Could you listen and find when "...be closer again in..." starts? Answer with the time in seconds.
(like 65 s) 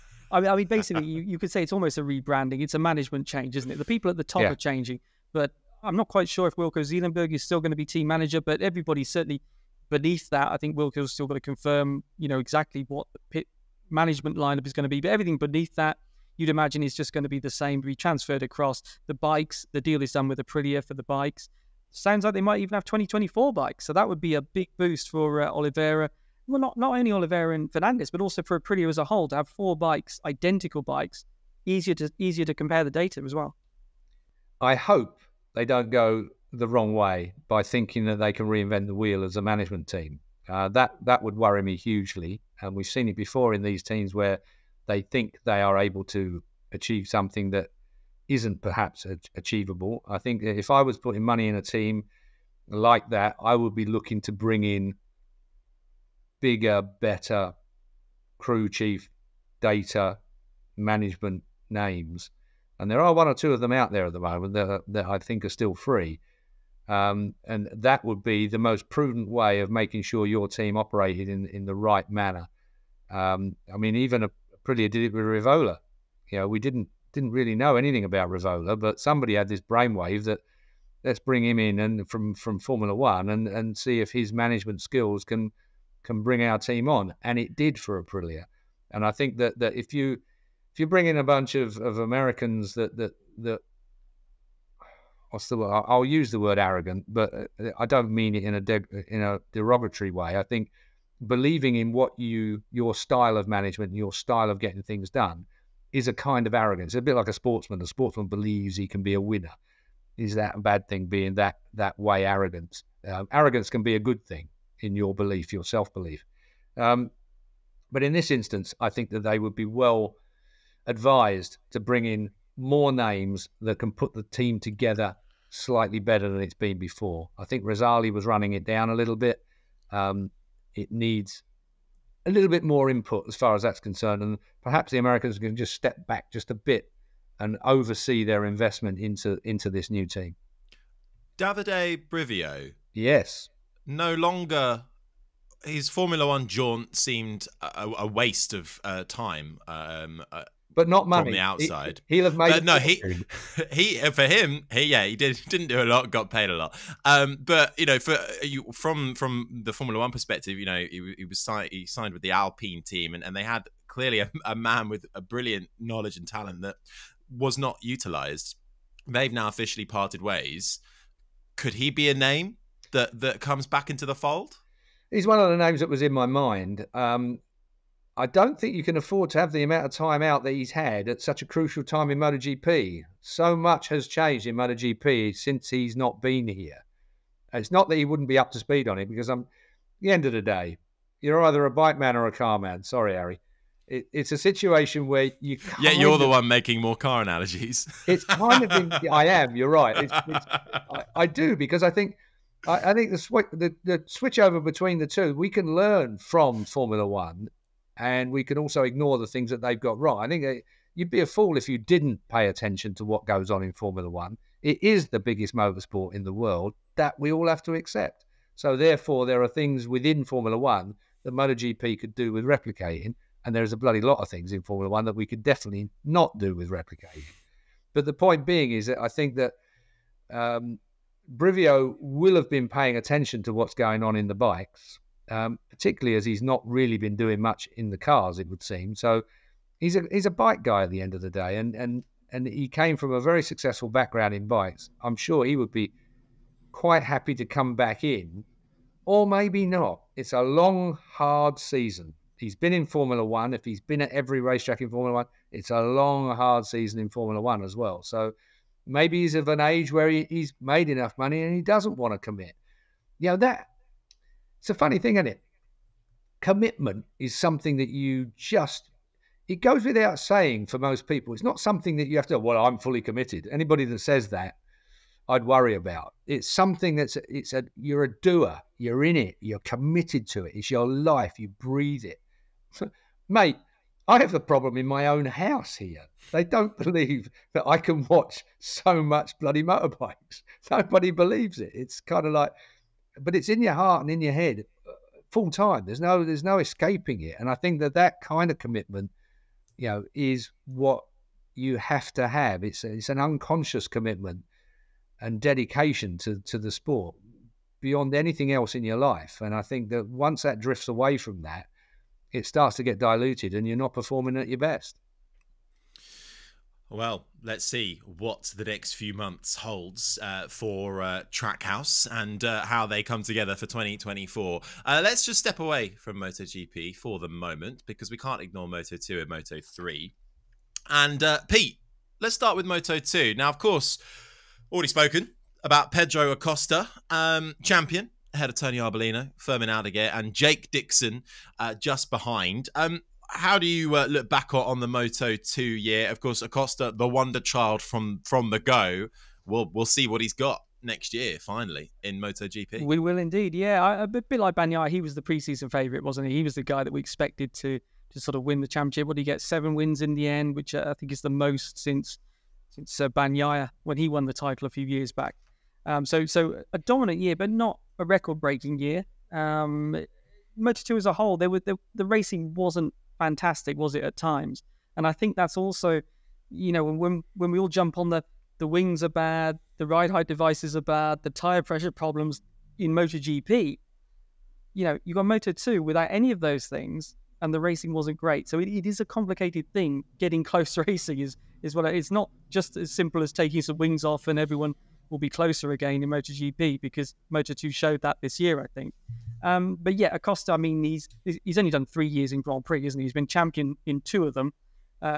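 395 s.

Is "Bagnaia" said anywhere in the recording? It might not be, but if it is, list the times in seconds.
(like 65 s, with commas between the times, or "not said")
354 s, 363 s.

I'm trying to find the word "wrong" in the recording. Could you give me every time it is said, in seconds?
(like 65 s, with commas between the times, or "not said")
36 s, 209 s.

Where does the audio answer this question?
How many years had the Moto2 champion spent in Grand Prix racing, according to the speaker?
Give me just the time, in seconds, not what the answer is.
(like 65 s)
401 s.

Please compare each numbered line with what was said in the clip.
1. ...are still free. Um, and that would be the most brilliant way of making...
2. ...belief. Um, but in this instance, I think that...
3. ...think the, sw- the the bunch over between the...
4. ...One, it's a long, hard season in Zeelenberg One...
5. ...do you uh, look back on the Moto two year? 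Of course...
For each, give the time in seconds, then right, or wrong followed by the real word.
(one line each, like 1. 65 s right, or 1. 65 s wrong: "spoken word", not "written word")
1. 65 s wrong: "prudent", not "brilliant"
2. 115 s right
3. 202 s wrong: "switch", not "bunch"
4. 255 s wrong: "Formula", not "Zeelenberg"
5. 343 s right.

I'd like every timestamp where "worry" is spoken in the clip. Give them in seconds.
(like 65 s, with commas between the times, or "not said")
41 s, 275 s.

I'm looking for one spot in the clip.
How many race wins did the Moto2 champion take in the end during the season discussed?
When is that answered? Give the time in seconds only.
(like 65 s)
359 s.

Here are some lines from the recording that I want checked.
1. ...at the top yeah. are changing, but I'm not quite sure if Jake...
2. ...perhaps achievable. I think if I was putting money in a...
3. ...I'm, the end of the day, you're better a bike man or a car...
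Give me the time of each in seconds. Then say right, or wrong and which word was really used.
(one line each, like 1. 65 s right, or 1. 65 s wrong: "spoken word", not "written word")
1. 4 s wrong: "Wilco", not "Jake"
2. 48 s right
3. 189 s wrong: "either", not "better".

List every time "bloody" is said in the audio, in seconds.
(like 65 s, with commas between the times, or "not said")
223 s, 289 s.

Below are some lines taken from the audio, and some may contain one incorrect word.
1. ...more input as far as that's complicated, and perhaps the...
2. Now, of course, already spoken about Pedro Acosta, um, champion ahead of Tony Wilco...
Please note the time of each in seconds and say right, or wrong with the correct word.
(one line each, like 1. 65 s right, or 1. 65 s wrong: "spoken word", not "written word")
1. 132 s wrong: "concerned", not "complicated"
2. 333 s wrong: "Arbolino", not "Wilco".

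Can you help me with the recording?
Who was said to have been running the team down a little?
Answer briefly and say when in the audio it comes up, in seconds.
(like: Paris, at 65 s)
Razali, at 127 s.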